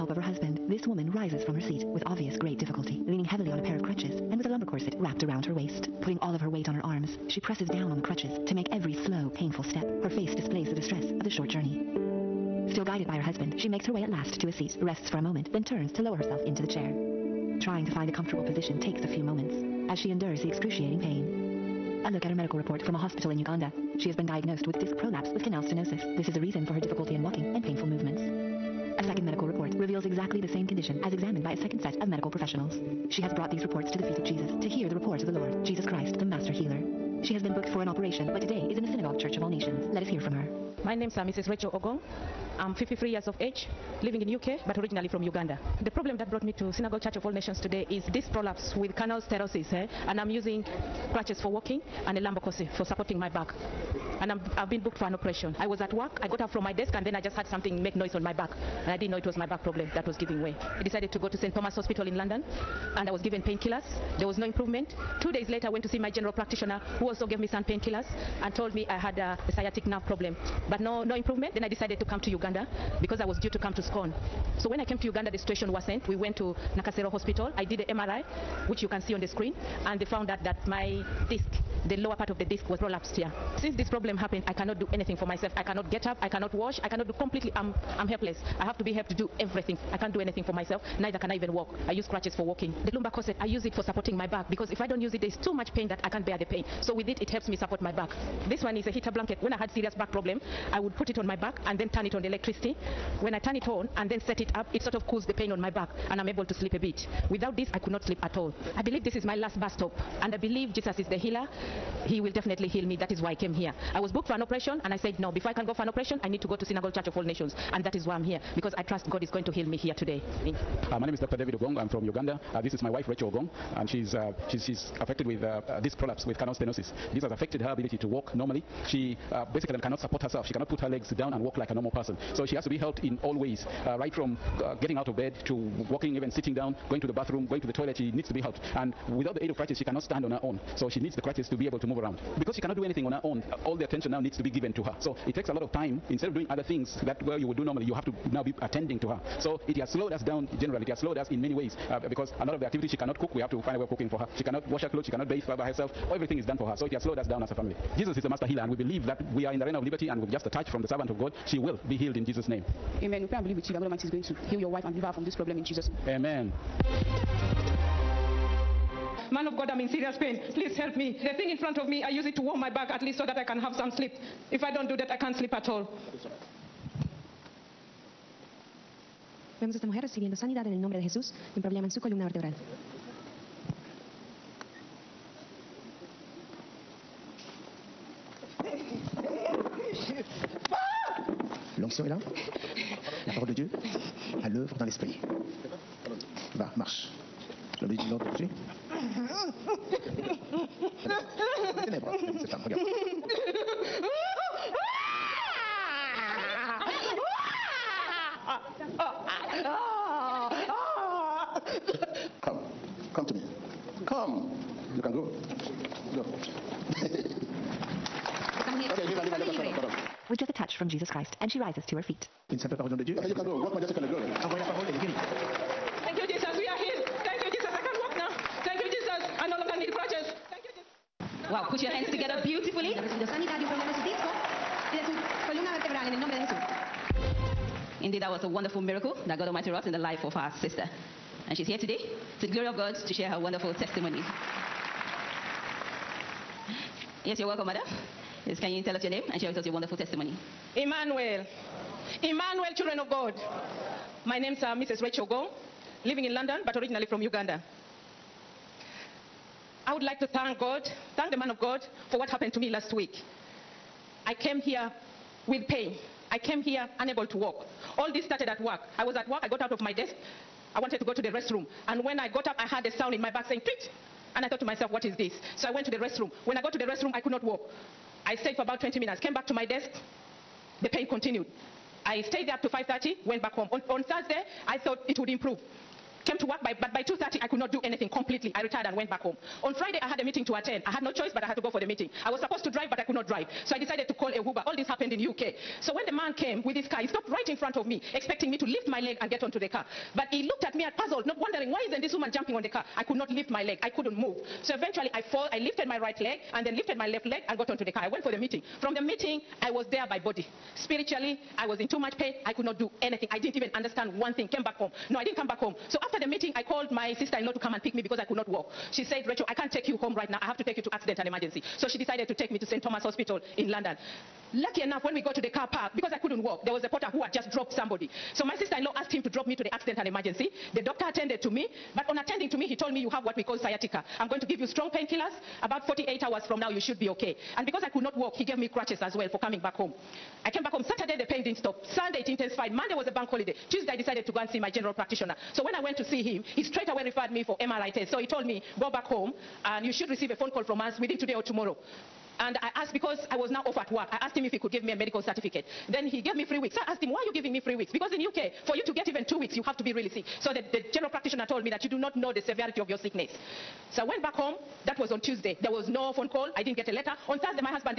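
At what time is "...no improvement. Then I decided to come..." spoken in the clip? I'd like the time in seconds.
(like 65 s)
71 s.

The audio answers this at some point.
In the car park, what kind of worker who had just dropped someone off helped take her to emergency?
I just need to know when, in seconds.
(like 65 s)
326 s.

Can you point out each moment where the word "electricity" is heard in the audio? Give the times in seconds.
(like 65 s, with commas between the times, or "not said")
102 s.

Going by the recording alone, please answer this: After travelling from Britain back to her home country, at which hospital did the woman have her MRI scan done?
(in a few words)
Nakasero Hospital.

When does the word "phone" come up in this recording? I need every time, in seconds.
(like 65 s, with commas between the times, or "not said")
350 s, 366 s.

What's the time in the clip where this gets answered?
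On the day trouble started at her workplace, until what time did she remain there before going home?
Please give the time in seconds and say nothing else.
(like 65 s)
282 s.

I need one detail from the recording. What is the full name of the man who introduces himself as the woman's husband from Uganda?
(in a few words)
Dr. David Ogong.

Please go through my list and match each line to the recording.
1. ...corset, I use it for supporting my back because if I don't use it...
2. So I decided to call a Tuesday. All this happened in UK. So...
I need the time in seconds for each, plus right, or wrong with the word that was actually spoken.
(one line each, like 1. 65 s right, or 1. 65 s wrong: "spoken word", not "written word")
1. 93 s right
2. 293 s wrong: "Uber", not "Tuesday".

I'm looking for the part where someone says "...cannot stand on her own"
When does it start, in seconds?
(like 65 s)
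139 s.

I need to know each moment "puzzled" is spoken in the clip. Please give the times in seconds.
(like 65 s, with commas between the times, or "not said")
300 s.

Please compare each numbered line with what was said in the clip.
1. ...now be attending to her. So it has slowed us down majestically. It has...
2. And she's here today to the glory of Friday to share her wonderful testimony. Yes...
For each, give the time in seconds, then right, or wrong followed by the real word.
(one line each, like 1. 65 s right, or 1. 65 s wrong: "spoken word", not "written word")
1. 148 s wrong: "generally", not "majestically"
2. 241 s wrong: "God", not "Friday".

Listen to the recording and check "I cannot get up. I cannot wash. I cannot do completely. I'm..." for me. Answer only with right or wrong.
right.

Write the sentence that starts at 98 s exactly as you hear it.
This one is a heater blanket.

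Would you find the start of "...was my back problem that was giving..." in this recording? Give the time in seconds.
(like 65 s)
59 s.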